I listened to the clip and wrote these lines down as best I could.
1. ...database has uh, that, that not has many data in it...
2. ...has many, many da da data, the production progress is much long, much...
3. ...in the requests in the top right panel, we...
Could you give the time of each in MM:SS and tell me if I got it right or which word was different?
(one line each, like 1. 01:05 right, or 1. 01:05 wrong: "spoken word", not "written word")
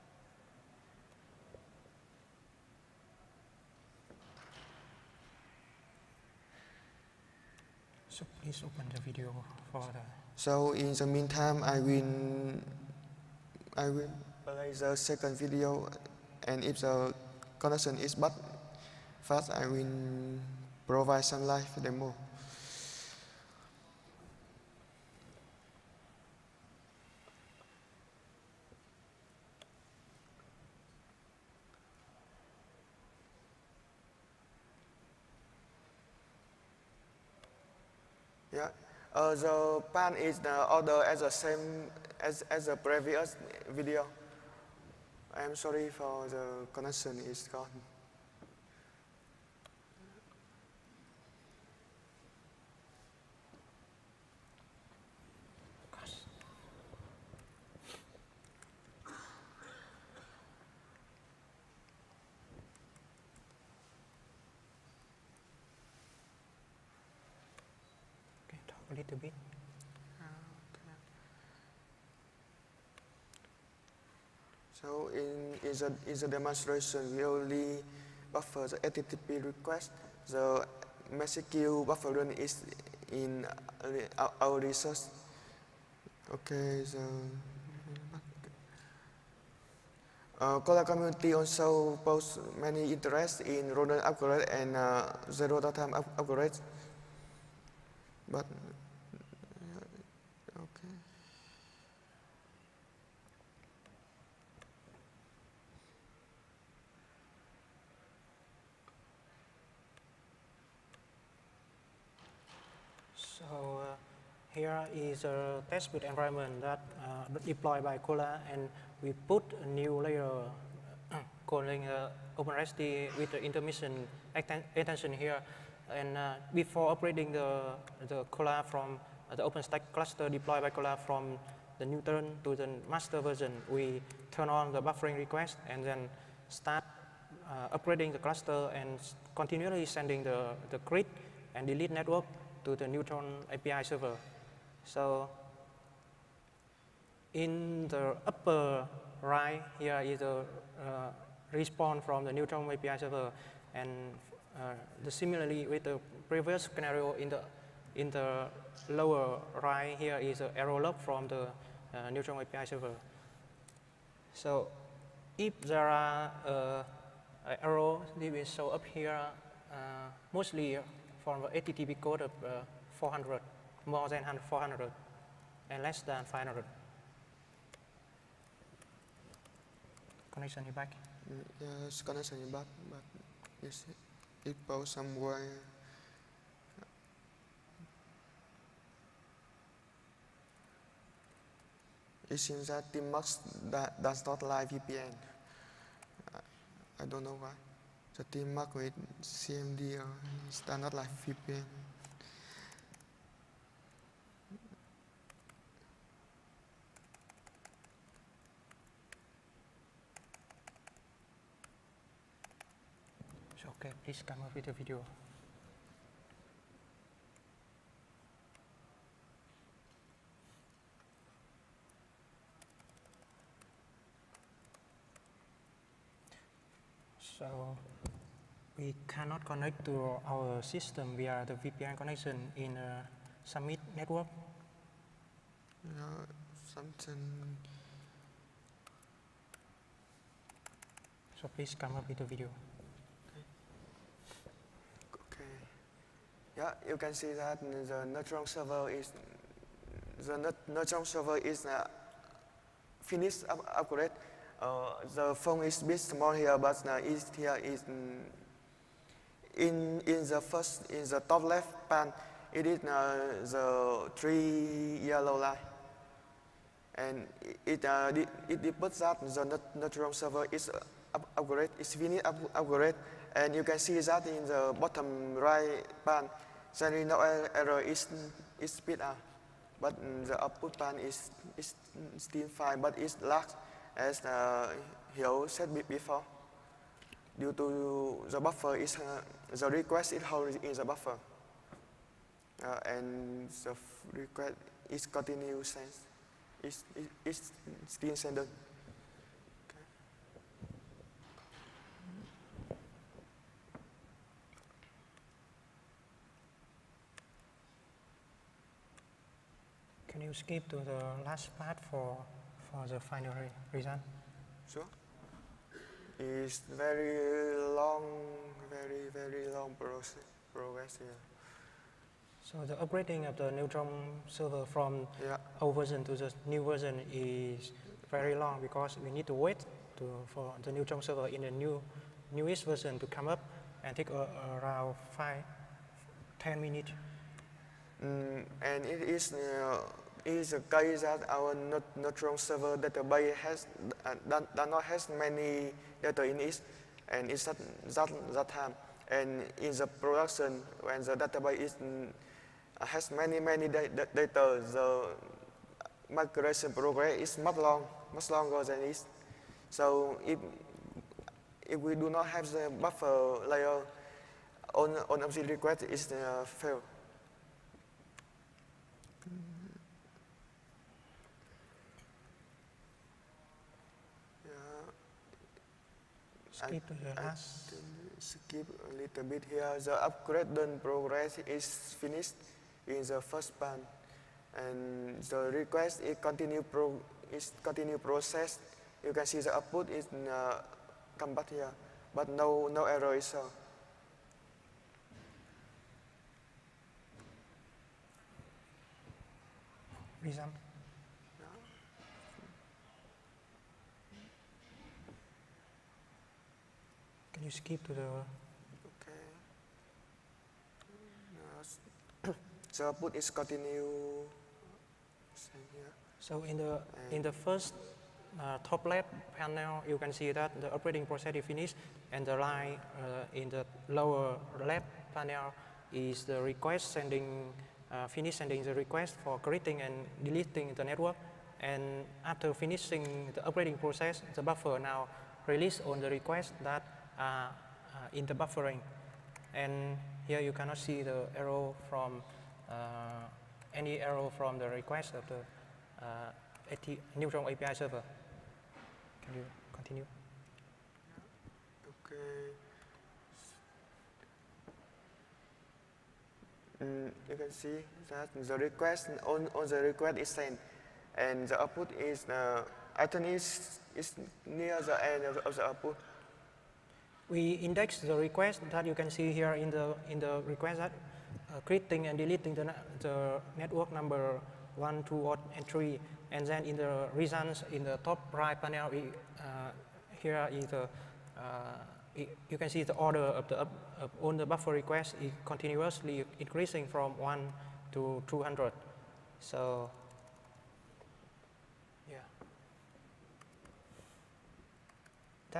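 1. 05:42 right
2. 05:52 wrong: "migration", not "production"
3. 07:56 wrong: "results", not "requests".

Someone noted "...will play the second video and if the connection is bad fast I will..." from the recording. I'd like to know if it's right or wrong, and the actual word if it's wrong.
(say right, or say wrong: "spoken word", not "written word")
right.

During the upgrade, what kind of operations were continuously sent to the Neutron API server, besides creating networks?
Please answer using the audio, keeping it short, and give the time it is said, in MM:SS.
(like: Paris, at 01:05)
delete network, at 02:21.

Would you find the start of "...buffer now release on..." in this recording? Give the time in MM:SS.
07:14.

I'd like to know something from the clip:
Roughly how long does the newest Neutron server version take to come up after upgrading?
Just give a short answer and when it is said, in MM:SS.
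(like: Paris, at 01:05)
5 to 10 minutes, at 05:35.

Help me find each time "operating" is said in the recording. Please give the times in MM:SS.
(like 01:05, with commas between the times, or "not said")
07:00, 07:13.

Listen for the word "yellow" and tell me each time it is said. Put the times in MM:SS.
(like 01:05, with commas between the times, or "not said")
04:25.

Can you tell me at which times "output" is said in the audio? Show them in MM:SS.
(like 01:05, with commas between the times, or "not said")
04:40, 06:29, 06:52, 07:41, 07:45.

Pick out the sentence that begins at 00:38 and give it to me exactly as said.
Yeah, uh, the pan is the order as the same as as the previous video.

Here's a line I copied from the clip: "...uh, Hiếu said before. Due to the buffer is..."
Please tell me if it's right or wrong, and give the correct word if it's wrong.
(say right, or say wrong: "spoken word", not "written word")
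right.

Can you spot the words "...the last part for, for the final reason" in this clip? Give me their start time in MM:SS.
05:10.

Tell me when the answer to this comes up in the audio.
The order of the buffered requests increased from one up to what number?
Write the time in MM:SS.
08:08.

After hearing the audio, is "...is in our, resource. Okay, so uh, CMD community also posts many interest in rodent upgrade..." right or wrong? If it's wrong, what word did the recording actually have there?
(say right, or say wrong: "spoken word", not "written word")
wrong: "Kolla", not "CMD".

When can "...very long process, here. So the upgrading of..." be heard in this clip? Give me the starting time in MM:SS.
05:19.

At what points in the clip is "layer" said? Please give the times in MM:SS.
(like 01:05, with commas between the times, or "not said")
02:00, 06:03.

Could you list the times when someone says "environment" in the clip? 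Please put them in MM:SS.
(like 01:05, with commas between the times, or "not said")
01:56.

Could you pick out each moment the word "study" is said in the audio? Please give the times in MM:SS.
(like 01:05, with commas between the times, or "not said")
not said.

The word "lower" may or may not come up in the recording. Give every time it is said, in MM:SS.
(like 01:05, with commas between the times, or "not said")
02:38, 07:03.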